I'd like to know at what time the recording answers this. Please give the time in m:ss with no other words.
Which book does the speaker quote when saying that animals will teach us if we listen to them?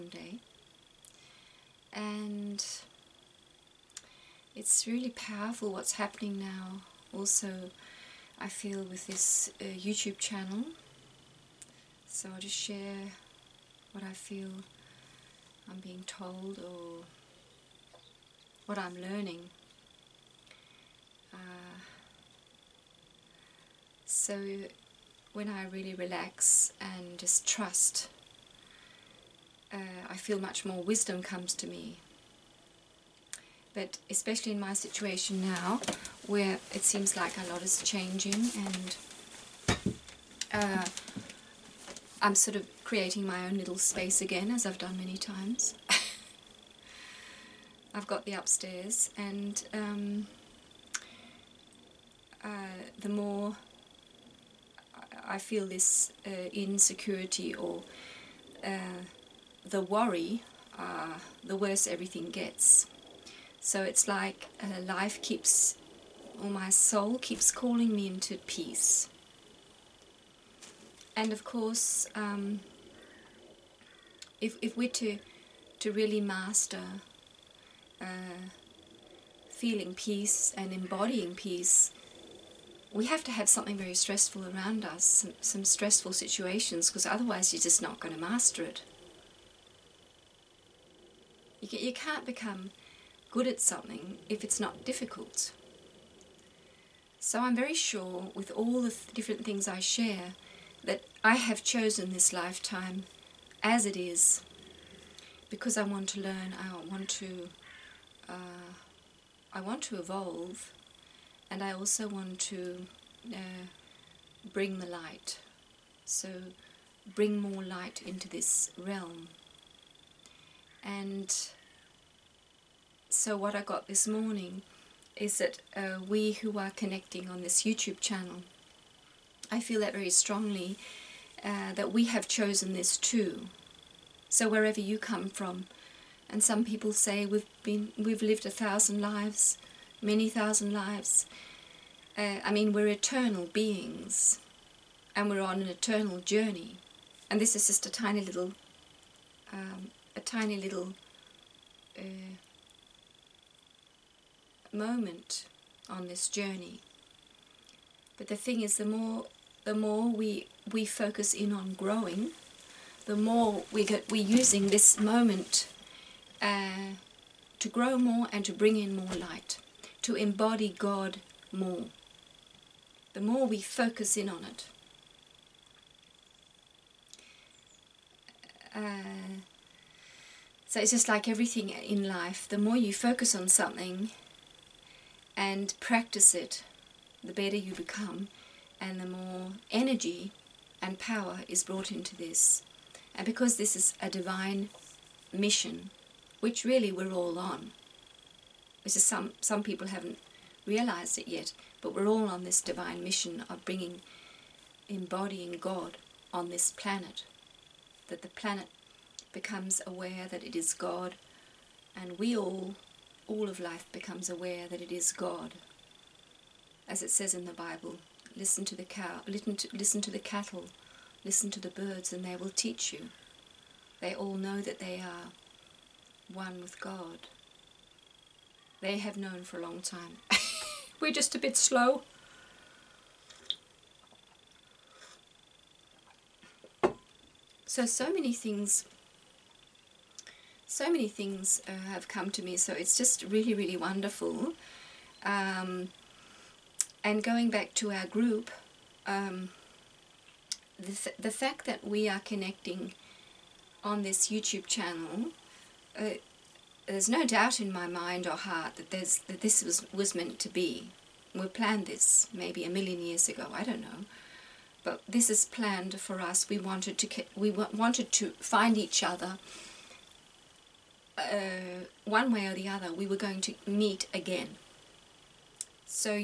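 3:37.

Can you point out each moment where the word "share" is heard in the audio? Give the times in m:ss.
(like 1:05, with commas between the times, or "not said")
0:12, 1:39.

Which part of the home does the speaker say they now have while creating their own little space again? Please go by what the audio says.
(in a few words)
The upstairs.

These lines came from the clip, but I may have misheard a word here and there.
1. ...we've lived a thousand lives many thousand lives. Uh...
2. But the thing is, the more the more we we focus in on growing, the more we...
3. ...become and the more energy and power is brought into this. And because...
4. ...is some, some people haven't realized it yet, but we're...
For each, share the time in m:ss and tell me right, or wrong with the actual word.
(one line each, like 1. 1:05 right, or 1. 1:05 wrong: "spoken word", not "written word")
1. 2:17 right
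2. 2:38 right
3. 3:07 right
4. 3:18 right.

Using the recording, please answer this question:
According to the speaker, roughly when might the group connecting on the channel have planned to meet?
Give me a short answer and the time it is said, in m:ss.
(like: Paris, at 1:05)
A million years ago, at 4:22.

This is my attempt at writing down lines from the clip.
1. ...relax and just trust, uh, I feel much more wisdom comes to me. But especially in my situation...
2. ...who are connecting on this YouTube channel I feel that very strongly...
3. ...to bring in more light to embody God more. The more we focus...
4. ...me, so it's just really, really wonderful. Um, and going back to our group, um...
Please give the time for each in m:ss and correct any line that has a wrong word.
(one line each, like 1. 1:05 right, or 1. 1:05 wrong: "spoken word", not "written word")
1. 0:25 right
2. 2:06 right
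3. 2:48 right
4. 4:02 right.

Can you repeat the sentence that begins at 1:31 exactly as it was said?
You, you can't become good at something if it's not difficult.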